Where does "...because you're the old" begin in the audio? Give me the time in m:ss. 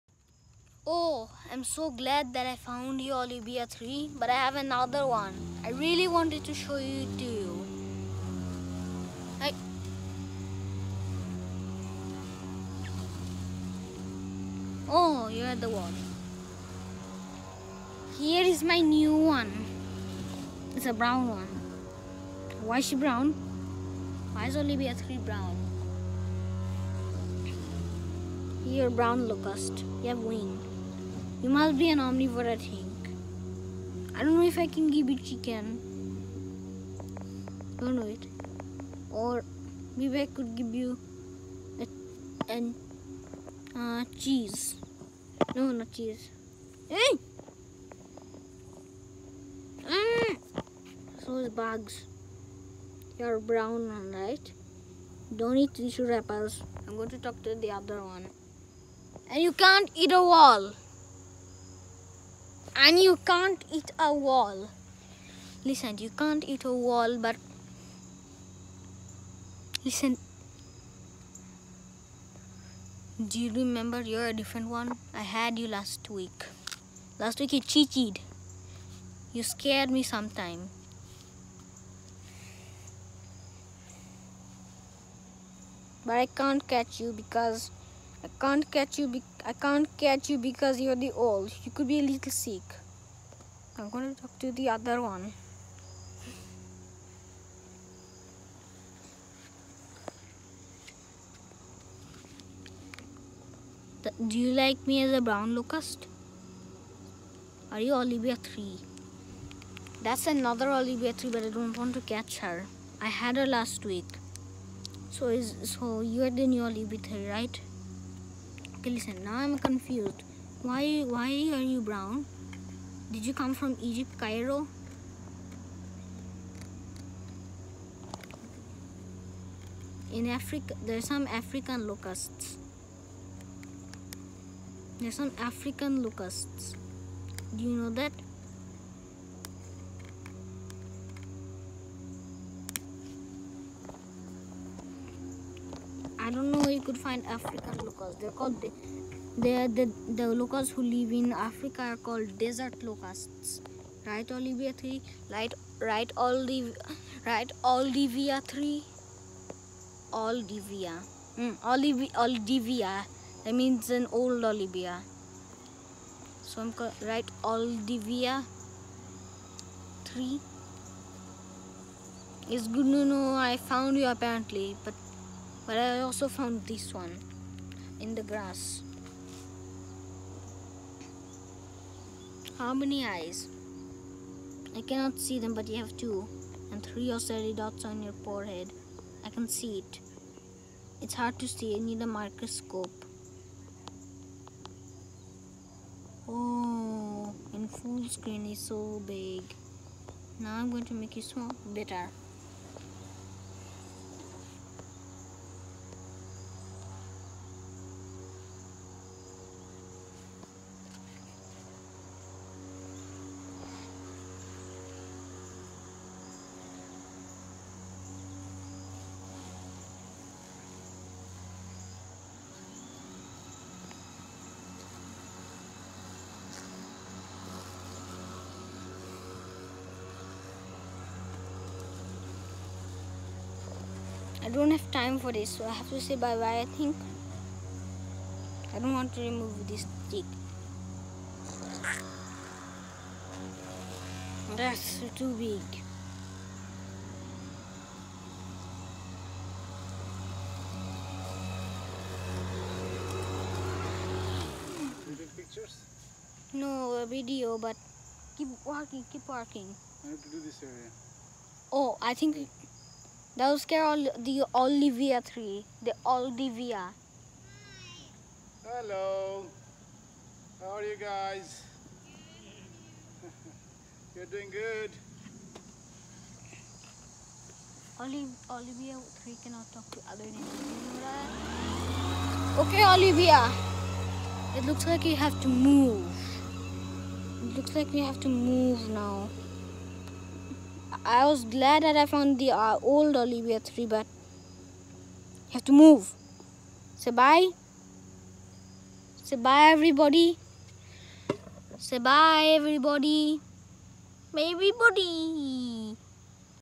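1:30.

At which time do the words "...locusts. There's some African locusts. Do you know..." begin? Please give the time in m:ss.
2:11.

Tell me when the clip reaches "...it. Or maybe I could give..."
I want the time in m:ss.
0:38.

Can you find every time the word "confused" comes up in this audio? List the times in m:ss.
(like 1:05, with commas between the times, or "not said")
1:59.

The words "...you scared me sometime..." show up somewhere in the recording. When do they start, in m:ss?
1:19.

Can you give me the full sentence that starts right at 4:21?
Oh, I think that was all the Olivia tree.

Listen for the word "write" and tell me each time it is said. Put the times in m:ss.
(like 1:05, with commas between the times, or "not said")
2:47.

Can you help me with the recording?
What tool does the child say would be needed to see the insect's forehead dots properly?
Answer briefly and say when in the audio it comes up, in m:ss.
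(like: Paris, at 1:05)
microscope, at 3:12.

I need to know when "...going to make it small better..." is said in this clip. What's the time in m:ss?
3:20.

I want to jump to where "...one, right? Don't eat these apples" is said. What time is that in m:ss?
0:53.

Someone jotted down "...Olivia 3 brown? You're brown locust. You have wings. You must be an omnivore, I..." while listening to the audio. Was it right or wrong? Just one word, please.
right.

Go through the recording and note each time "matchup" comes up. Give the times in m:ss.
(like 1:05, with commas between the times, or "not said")
not said.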